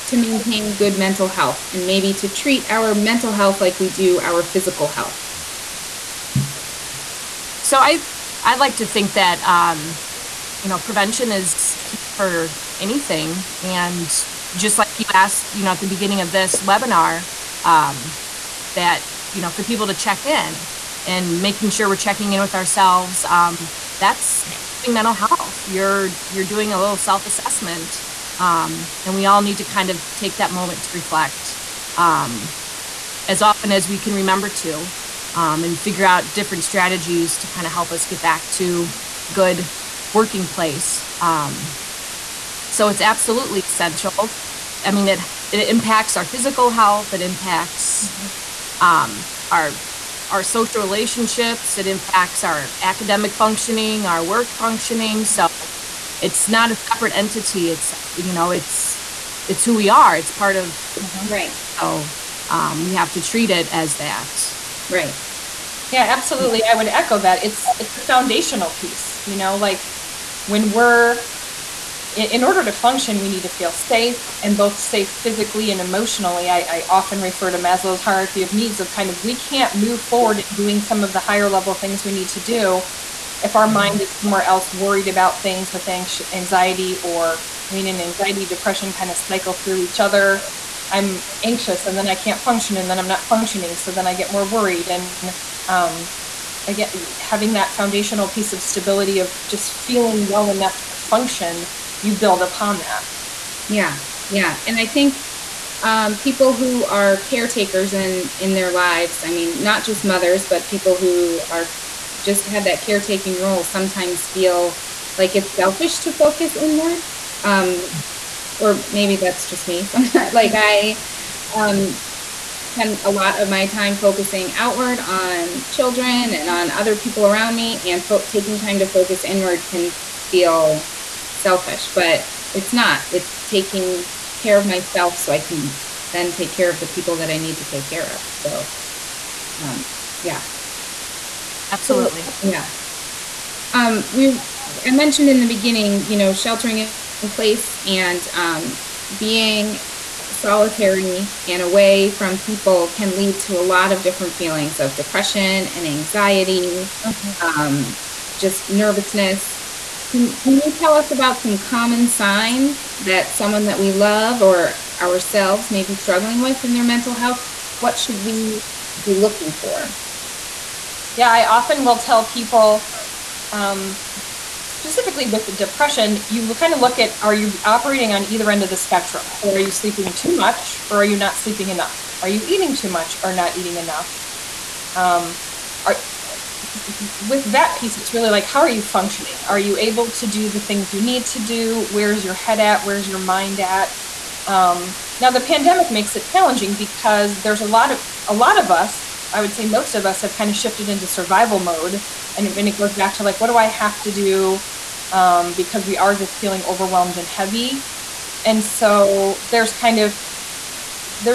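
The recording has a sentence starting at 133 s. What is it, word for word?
It's taking care of myself so I can then take care of the people that I need to take care of.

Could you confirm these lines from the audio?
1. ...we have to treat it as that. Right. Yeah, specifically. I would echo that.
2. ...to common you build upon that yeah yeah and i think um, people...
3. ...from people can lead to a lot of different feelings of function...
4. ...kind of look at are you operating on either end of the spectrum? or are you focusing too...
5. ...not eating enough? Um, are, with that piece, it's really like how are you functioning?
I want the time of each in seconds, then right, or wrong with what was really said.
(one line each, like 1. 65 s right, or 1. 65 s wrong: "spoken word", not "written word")
1. 62 s wrong: "absolutely", not "specifically"
2. 100 s wrong: "function", not "common"
3. 152 s wrong: "depression", not "function"
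4. 176 s wrong: "sleeping", not "focusing"
5. 183 s right.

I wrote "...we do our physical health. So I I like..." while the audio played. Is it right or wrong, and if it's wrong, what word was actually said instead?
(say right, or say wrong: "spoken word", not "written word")
right.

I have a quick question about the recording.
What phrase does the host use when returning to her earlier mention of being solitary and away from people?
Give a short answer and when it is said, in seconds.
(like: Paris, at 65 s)
sheltering in place, at 146 s.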